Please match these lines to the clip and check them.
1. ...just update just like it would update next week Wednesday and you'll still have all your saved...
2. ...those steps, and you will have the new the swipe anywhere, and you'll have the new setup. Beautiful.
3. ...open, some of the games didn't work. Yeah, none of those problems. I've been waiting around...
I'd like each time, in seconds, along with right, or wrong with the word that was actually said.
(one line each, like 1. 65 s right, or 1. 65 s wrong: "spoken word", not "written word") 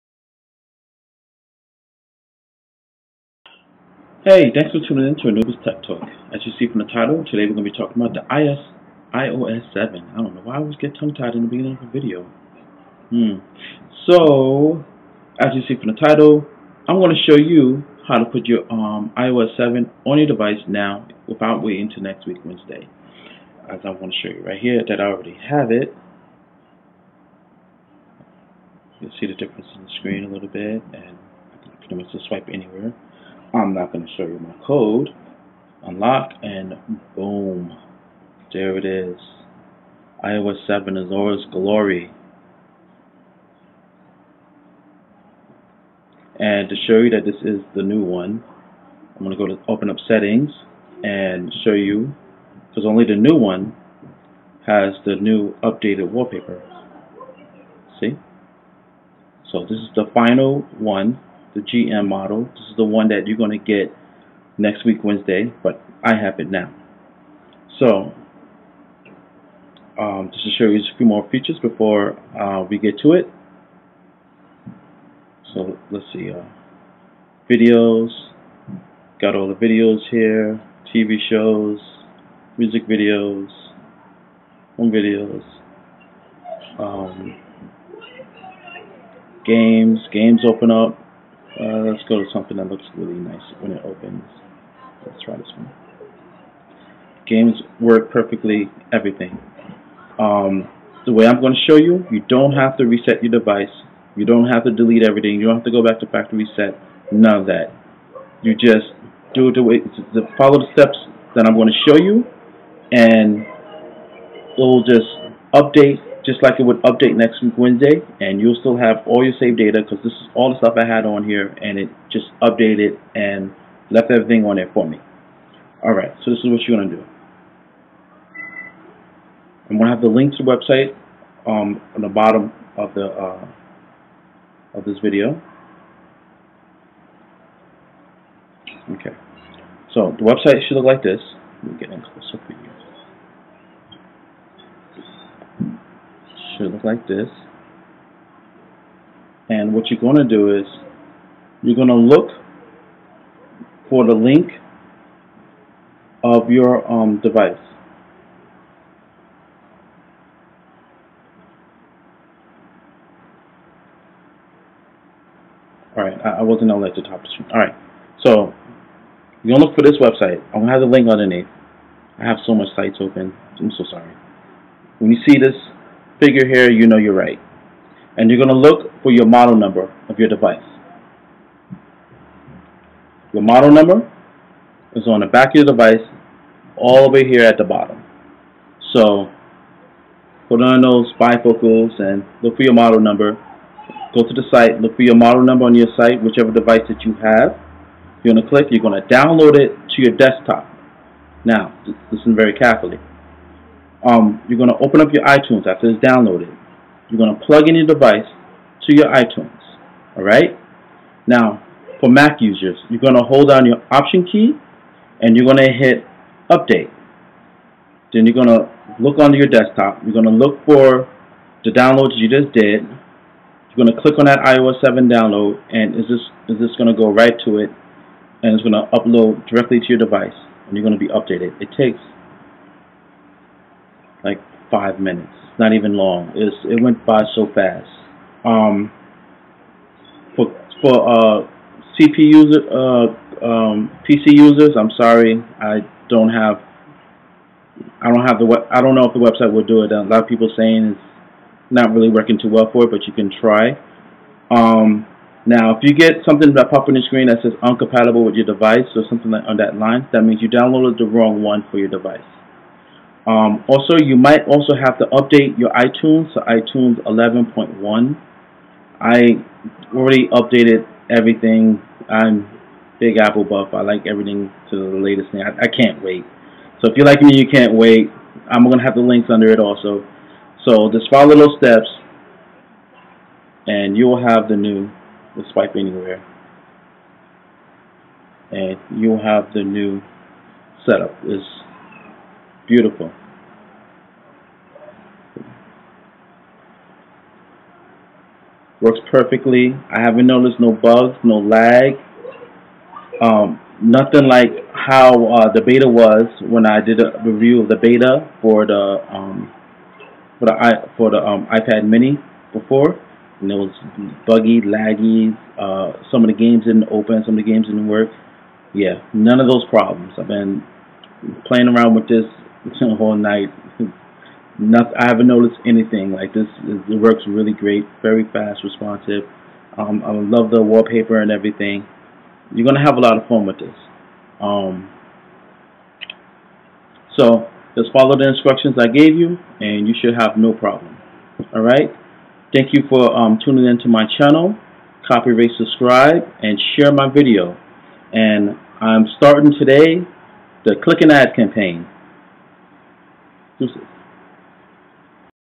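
1. 114 s right
2. 281 s right
3. 316 s wrong: "playing", not "waiting".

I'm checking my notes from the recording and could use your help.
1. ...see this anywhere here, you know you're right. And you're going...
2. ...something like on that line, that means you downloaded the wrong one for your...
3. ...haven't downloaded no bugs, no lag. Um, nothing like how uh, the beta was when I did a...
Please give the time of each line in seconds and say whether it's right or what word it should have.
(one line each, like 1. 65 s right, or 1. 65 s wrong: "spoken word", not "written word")
1. 175 s wrong: "figure", not "anywhere"
2. 259 s right
3. 300 s wrong: "noticed", not "downloaded".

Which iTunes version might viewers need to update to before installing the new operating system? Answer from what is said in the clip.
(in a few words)
iTunes 11.1.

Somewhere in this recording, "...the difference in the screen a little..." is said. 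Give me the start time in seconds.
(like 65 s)
29 s.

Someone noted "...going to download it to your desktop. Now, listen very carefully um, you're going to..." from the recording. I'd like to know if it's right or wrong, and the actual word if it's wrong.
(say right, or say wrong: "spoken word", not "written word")
right.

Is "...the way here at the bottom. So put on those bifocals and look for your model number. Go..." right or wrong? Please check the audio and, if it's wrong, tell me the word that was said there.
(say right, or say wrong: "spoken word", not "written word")
right.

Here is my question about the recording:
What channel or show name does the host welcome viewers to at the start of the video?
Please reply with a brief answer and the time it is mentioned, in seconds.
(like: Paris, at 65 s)
Anubis Tech Talk, at 5 s.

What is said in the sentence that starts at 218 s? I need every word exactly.
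Then you're going to look onto your desktop.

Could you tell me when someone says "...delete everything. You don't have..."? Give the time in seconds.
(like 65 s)
104 s.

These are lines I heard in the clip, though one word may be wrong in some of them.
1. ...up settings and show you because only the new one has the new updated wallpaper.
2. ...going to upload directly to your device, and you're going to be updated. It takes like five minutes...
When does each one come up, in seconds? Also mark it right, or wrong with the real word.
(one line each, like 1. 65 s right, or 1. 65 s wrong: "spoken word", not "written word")
1. 49 s right
2. 228 s right.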